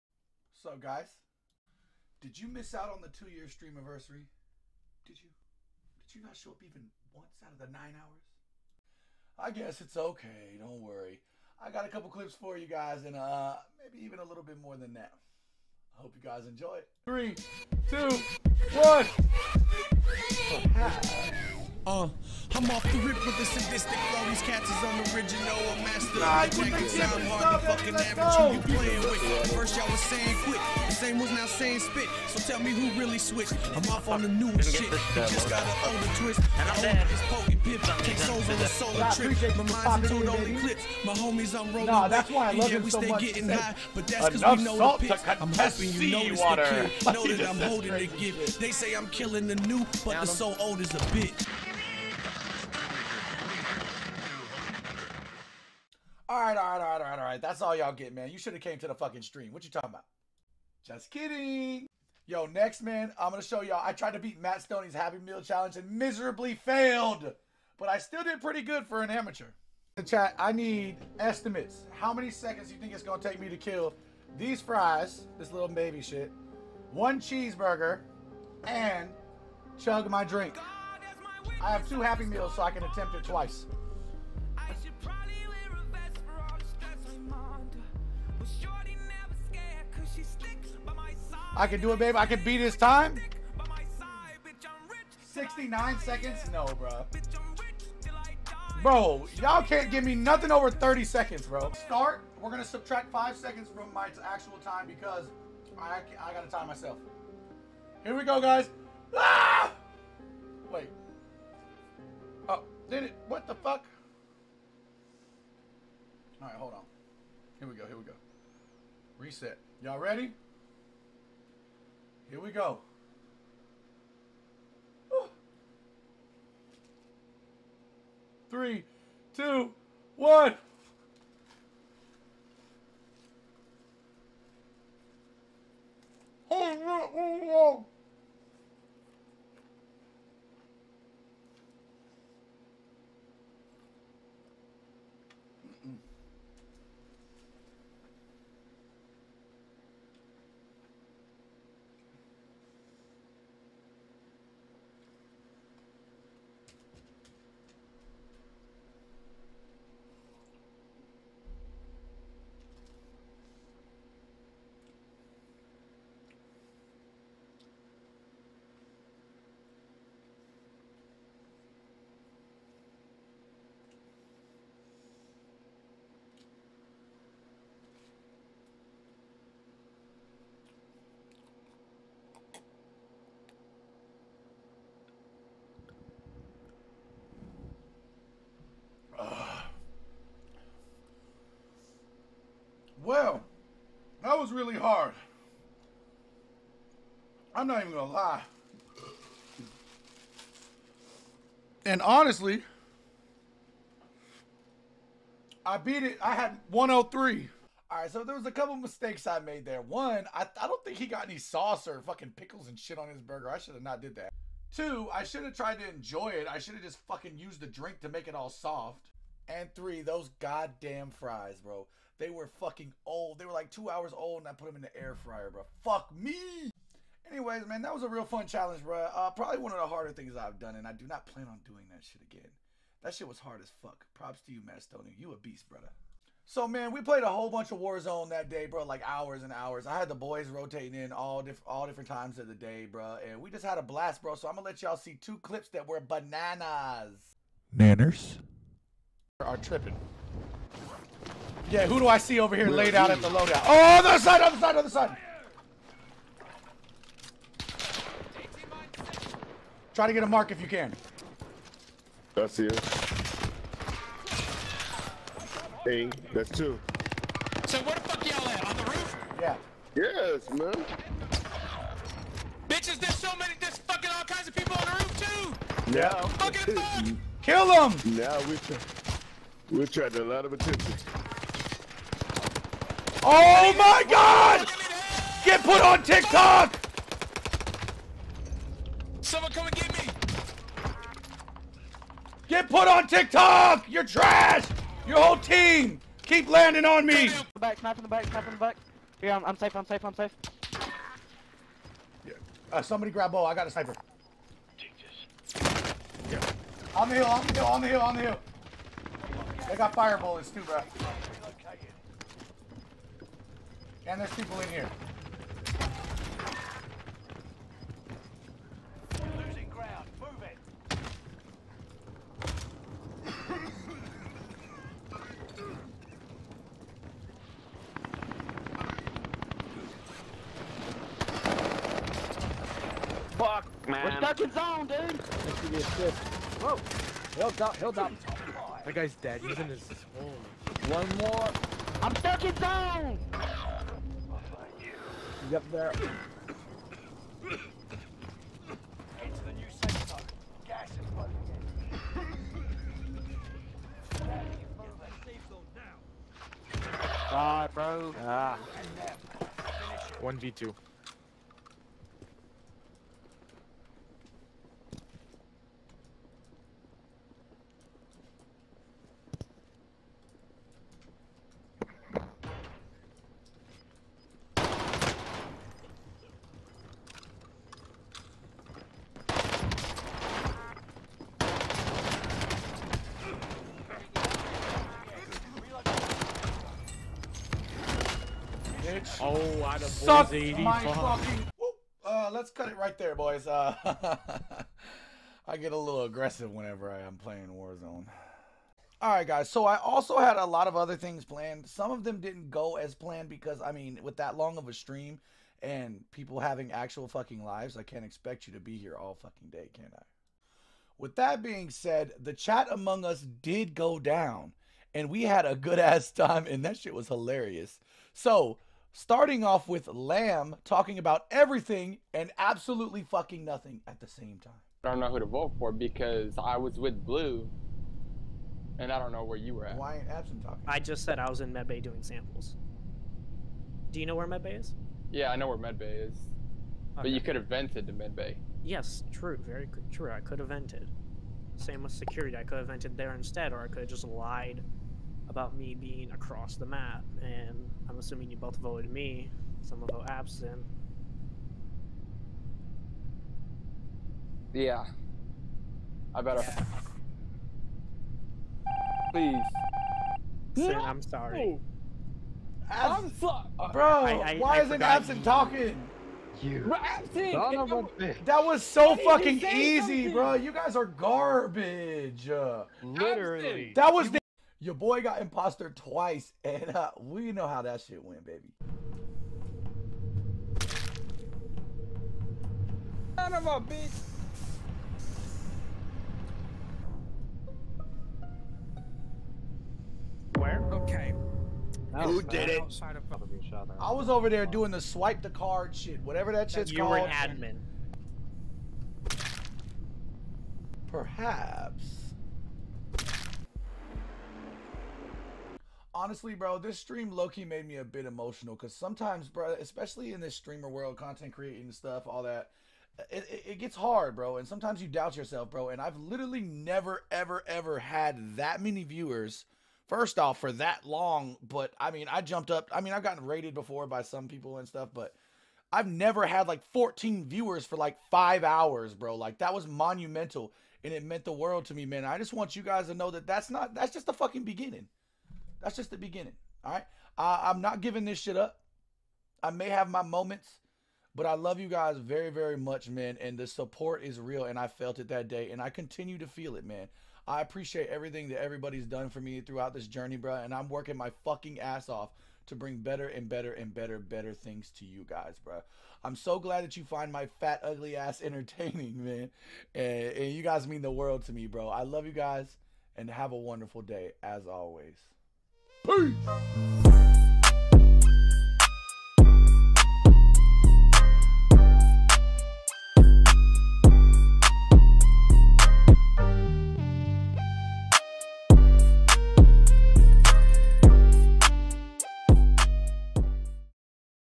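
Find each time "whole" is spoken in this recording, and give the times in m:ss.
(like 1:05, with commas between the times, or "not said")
3:57, 4:55.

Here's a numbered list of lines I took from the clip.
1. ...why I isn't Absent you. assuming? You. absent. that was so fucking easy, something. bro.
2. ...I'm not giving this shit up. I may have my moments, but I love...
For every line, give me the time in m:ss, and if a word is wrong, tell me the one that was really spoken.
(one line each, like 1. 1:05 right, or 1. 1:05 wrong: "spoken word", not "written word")
1. 7:44 wrong: "talking", not "assuming"
2. 8:57 right.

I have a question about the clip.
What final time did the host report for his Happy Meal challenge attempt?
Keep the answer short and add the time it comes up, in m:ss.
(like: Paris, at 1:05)
103, at 3:26.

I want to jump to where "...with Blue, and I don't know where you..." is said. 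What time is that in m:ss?
7:06.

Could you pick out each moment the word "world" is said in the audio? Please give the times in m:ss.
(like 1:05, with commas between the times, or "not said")
8:30, 8:51, 9:20.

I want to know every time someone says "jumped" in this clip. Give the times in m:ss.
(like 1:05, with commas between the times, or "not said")
8:42.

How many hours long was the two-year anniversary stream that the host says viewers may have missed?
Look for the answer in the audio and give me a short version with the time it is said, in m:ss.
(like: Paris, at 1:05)
9, at 0:07.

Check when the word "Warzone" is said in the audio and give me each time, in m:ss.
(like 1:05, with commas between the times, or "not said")
3:57, 6:37.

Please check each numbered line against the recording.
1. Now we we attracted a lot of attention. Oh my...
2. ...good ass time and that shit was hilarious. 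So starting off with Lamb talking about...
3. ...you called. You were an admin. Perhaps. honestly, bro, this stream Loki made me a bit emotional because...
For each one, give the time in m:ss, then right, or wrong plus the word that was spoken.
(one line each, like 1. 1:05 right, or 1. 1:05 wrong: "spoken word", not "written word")
1. 4:38 right
2. 6:55 right
3. 8:16 right.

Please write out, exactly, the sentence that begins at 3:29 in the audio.
One, I, I don't think he got any sauce or fucking pickles and shit on his burger.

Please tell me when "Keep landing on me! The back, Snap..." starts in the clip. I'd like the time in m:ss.
4:56.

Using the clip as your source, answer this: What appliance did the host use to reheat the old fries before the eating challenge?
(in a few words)
Air fryer.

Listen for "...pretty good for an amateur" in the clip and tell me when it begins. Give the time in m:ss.
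1:08.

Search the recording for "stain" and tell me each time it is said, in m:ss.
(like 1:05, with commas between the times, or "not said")
not said.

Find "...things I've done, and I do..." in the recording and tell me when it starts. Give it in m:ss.
3:50.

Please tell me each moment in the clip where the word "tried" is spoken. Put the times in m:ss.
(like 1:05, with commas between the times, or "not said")
1:03, 3:35.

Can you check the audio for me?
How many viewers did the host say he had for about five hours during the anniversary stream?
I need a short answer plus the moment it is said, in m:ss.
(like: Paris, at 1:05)
14, at 8:46.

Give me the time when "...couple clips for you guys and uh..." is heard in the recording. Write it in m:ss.
0:11.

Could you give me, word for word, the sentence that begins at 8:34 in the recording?
And sometimes you doubt yourself, bro.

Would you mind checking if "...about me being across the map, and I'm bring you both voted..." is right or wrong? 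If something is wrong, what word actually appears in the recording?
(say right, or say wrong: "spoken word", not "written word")
wrong: "assuming", not "bring".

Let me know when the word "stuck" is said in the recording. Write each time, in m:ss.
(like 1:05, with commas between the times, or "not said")
5:34, 5:42.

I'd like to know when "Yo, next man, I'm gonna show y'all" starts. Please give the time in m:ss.
1:02.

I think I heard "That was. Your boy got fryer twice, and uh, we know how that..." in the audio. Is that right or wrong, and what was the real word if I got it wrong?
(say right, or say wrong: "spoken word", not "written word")
wrong: "imposter", not "fryer".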